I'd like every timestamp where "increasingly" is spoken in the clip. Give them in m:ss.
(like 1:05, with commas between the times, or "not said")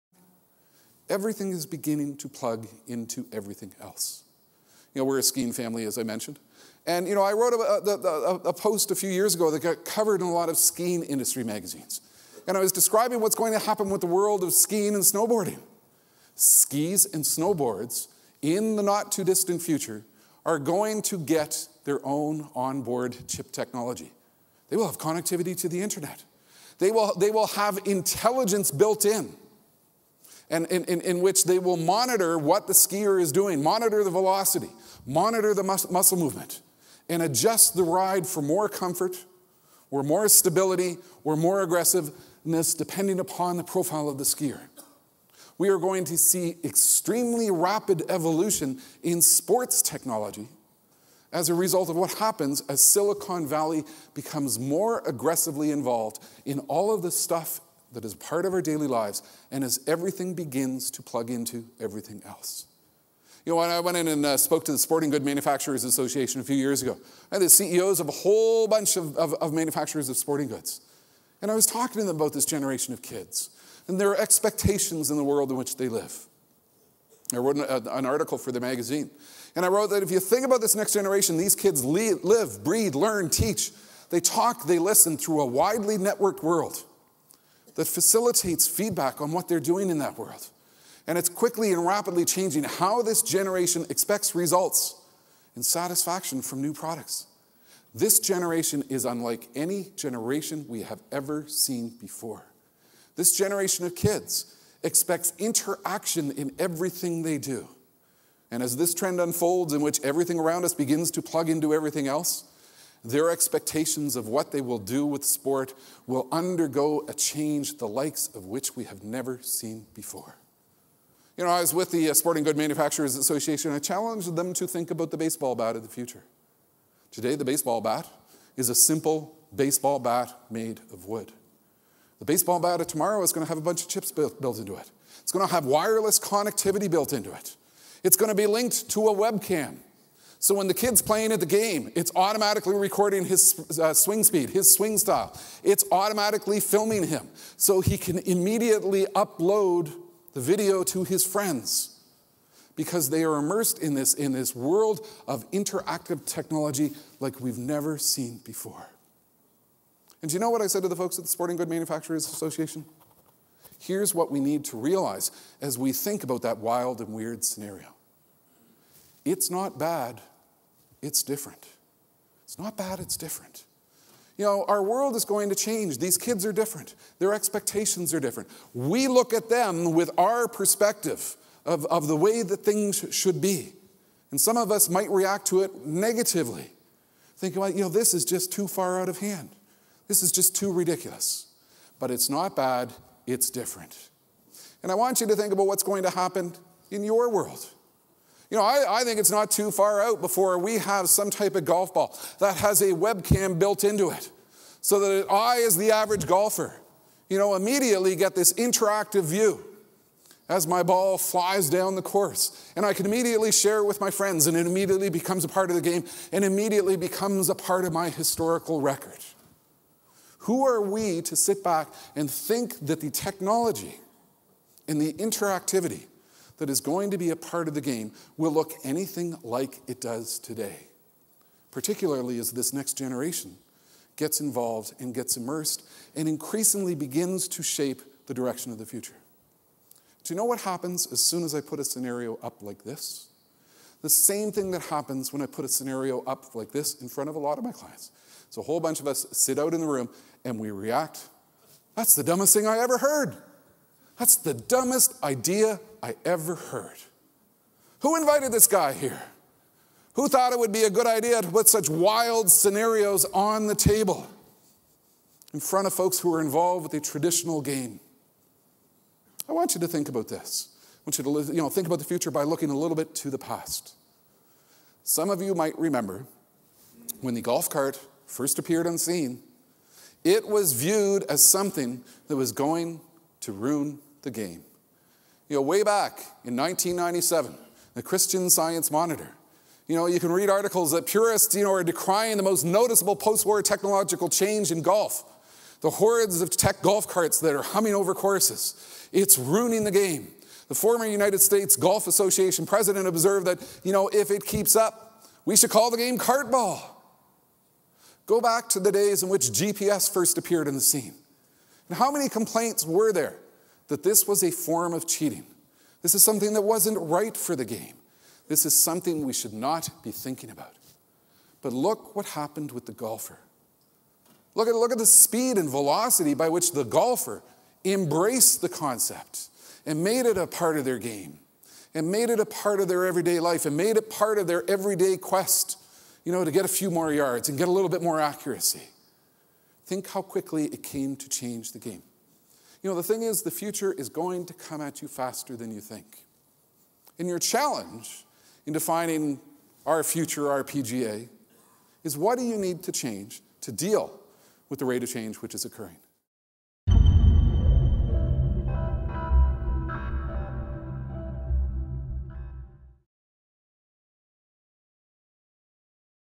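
3:56.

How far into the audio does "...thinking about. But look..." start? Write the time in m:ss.
5:20.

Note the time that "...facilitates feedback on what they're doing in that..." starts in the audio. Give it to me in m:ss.
1:27.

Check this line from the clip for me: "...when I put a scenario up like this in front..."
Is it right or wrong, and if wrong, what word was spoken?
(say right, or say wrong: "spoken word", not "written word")
right.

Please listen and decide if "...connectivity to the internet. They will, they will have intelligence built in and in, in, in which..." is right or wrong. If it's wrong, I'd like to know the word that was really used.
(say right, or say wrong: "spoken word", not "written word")
right.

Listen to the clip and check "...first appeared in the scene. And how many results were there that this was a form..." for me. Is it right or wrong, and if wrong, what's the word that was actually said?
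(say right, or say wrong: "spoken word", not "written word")
wrong: "complaints", not "results".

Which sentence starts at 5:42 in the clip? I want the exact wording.
You know, the thing is, the future is going to come at you faster than you think.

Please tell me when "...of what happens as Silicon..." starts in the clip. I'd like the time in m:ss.
0:51.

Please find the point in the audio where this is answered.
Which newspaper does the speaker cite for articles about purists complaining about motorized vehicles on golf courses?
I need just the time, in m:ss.
4:48.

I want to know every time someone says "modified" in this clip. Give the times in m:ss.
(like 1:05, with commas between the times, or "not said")
not said.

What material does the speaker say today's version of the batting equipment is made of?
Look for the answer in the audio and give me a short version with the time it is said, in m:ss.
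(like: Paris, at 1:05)
Wood, at 2:11.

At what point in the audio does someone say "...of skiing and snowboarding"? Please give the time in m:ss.
0:14.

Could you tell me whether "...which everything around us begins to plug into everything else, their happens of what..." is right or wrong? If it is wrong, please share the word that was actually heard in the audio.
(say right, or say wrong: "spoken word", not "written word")
wrong: "expectations", not "happens".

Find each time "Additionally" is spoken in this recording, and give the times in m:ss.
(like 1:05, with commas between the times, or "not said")
not said.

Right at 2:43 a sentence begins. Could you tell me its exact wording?
Here's what we need to realize as we think about that wild and weird scenario.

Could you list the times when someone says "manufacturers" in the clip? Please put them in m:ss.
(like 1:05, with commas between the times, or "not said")
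1:05, 1:09, 2:02, 2:41.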